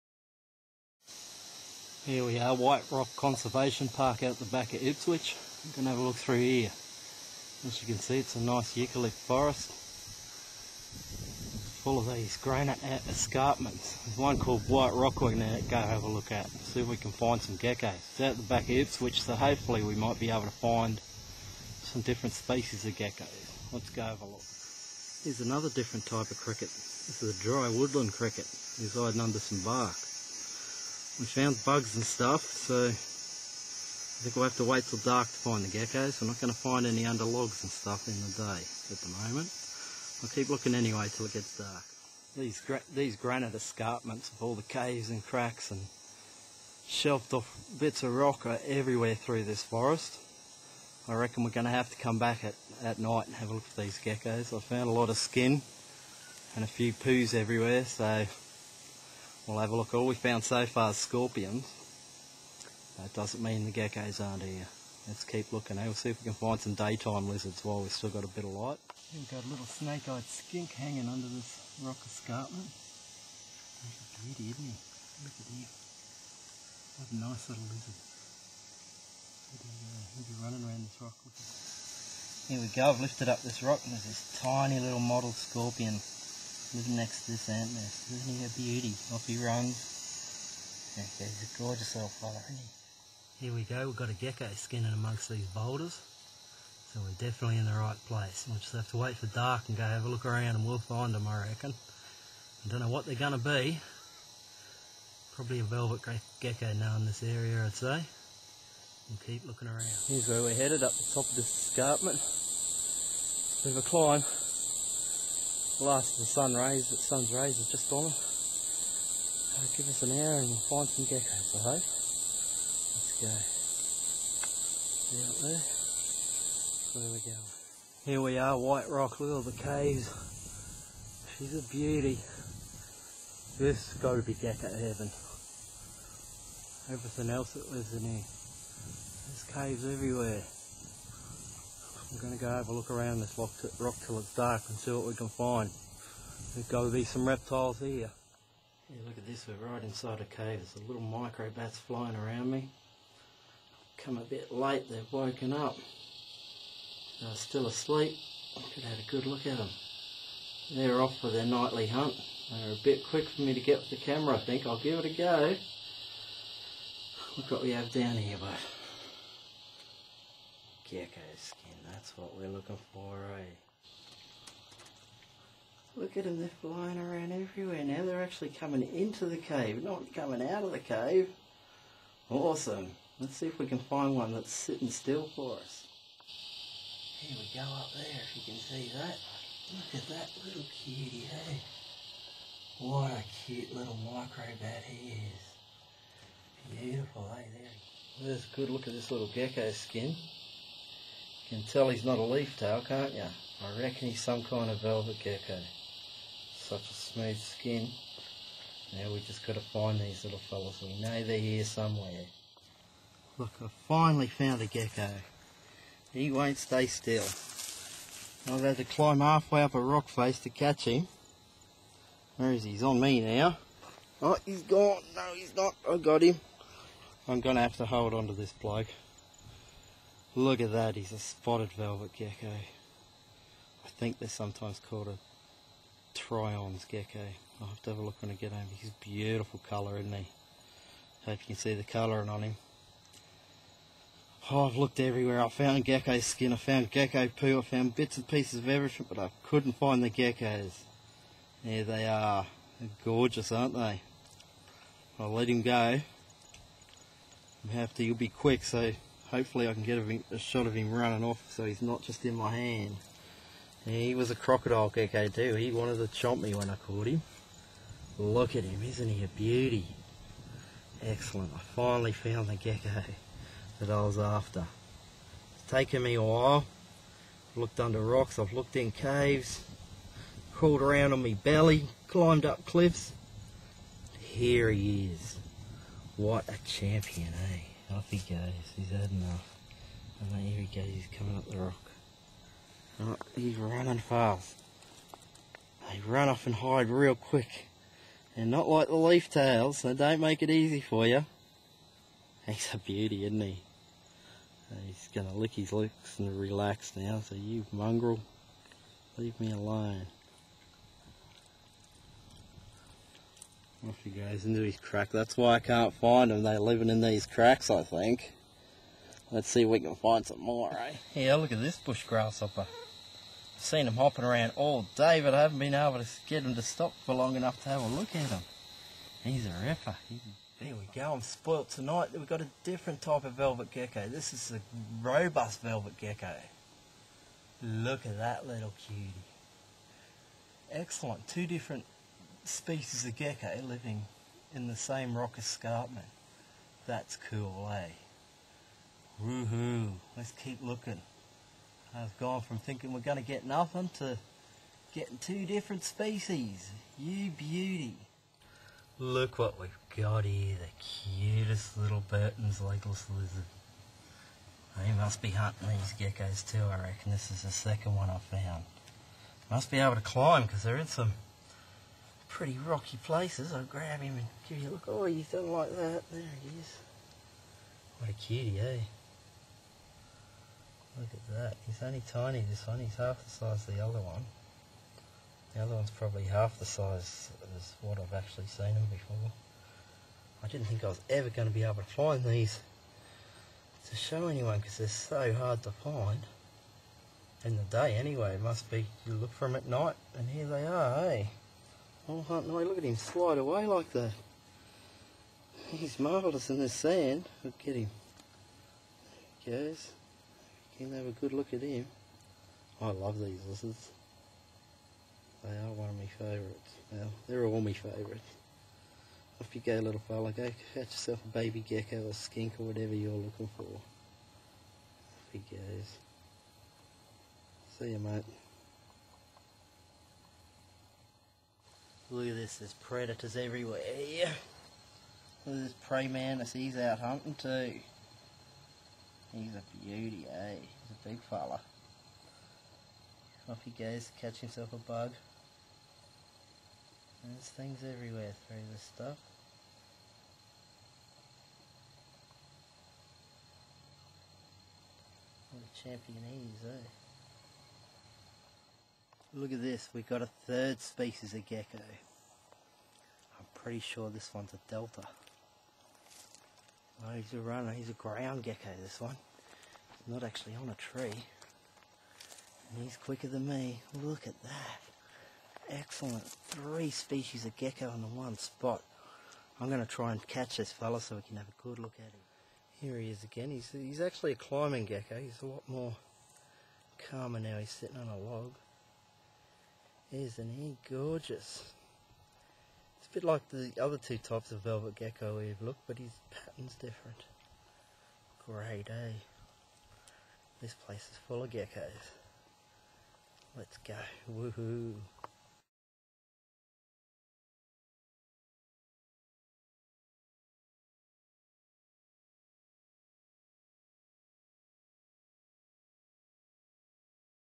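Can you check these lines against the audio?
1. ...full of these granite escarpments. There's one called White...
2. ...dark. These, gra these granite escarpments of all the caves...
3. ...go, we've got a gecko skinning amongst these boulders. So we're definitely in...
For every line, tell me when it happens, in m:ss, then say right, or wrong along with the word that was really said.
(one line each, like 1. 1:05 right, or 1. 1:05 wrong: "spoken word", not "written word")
1. 0:11 right
2. 0:41 right
3. 1:33 right.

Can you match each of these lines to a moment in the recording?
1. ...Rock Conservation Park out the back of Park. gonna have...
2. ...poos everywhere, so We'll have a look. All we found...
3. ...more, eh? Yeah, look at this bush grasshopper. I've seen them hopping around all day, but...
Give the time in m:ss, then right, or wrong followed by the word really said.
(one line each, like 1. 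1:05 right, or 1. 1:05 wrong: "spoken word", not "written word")
1. 0:02 wrong: "Ipswich", not "Park"
2. 0:56 right
3. 5:20 right.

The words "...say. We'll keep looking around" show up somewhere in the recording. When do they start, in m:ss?
1:47.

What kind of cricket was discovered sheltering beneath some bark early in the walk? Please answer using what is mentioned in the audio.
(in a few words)
dry woodland cricket.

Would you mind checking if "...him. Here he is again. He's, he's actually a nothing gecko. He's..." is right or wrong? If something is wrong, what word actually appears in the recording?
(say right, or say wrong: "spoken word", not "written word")
wrong: "climbing", not "nothing".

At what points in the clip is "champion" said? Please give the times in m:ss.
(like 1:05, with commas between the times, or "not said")
4:46, 7:35.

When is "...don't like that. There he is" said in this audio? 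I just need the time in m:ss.
6:15.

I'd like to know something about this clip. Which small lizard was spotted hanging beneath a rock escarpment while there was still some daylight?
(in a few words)
snake-eyed skink.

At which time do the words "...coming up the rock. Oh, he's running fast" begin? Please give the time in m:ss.
4:51.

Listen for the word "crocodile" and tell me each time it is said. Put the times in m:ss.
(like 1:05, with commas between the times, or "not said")
4:24.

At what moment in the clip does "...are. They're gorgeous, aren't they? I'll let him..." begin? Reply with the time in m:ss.
4:12.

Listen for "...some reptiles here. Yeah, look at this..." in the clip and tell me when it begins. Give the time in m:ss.
2:27.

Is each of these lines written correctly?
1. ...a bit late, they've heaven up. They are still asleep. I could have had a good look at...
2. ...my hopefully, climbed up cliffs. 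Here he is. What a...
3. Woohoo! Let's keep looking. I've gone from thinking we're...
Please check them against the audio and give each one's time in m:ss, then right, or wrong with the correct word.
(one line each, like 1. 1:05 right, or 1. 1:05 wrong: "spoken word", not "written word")
1. 2:34 wrong: "woken", not "heaven"
2. 4:41 wrong: "belly", not "hopefully"
3. 5:49 right.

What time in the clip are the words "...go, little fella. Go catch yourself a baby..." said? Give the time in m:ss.
6:59.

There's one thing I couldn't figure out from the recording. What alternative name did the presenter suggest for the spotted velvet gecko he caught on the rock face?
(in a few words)
Tryon's gecko.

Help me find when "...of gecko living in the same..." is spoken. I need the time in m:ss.
5:43.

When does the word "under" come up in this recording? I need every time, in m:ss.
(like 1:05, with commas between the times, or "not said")
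0:29, 0:37, 1:11, 4:37.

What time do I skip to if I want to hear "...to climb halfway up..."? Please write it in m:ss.
3:38.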